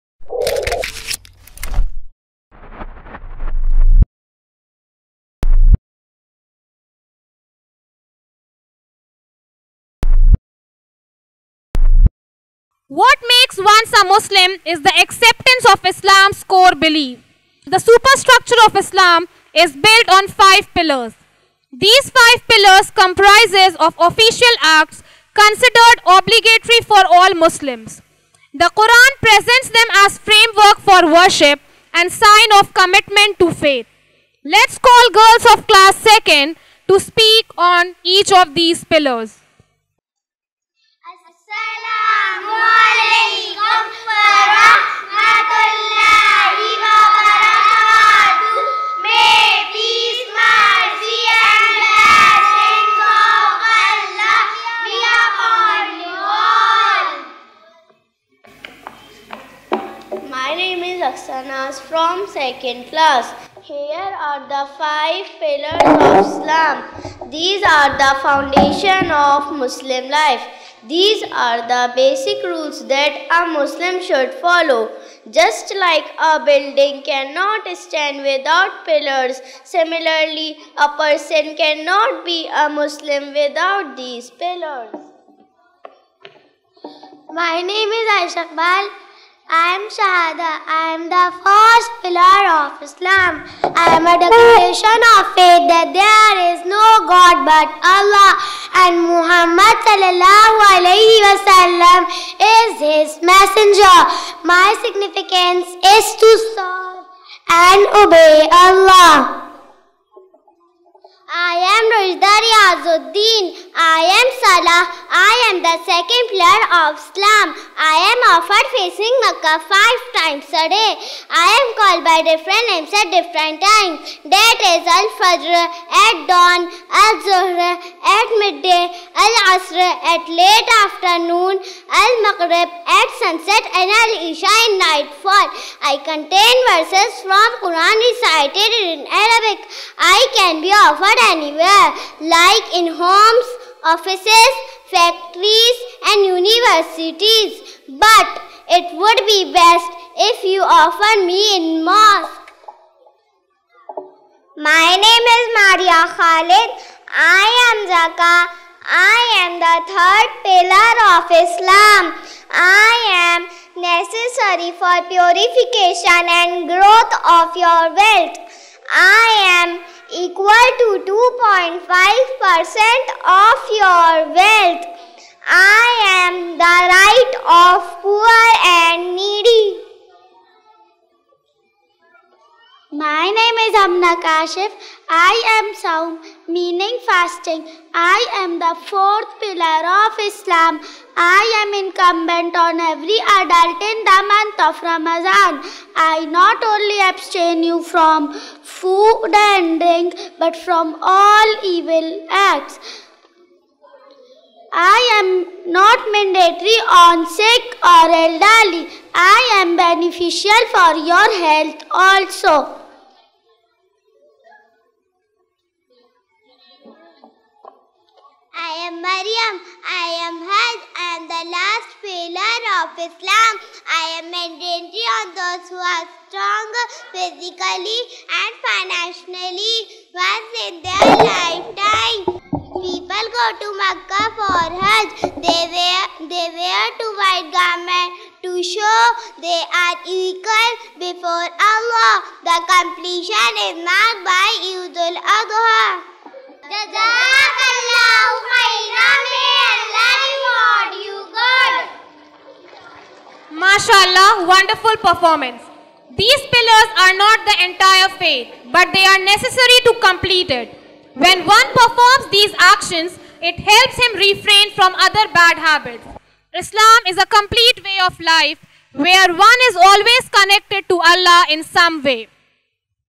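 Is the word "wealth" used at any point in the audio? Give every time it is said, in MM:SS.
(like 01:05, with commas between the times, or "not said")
02:47, 02:54.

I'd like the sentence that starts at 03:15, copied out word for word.
I not only abstain you from food and drink, but from all evil acts.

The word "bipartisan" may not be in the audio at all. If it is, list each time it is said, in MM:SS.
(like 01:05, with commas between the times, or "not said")
not said.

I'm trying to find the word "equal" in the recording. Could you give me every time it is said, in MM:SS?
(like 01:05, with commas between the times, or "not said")
02:50, 04:00.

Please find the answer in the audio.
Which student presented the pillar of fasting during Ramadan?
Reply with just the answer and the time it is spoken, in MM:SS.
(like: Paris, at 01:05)
Amna Kashif, at 03:03.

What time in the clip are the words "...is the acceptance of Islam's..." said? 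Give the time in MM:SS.
00:14.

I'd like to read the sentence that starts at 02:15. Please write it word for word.
I contain verses from Quran recited in Arabic.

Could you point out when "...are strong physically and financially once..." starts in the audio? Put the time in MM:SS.
03:45.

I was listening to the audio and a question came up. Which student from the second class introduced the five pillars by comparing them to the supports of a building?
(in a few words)
Aksana.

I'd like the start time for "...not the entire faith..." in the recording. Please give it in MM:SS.
04:17.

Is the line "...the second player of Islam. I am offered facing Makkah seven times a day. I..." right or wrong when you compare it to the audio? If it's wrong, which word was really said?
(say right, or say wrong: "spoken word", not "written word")
wrong: "five", not "seven".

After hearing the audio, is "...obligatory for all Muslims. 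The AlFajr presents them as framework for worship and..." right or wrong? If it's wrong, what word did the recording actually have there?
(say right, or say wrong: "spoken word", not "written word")
wrong: "Quran", not "AlFajr".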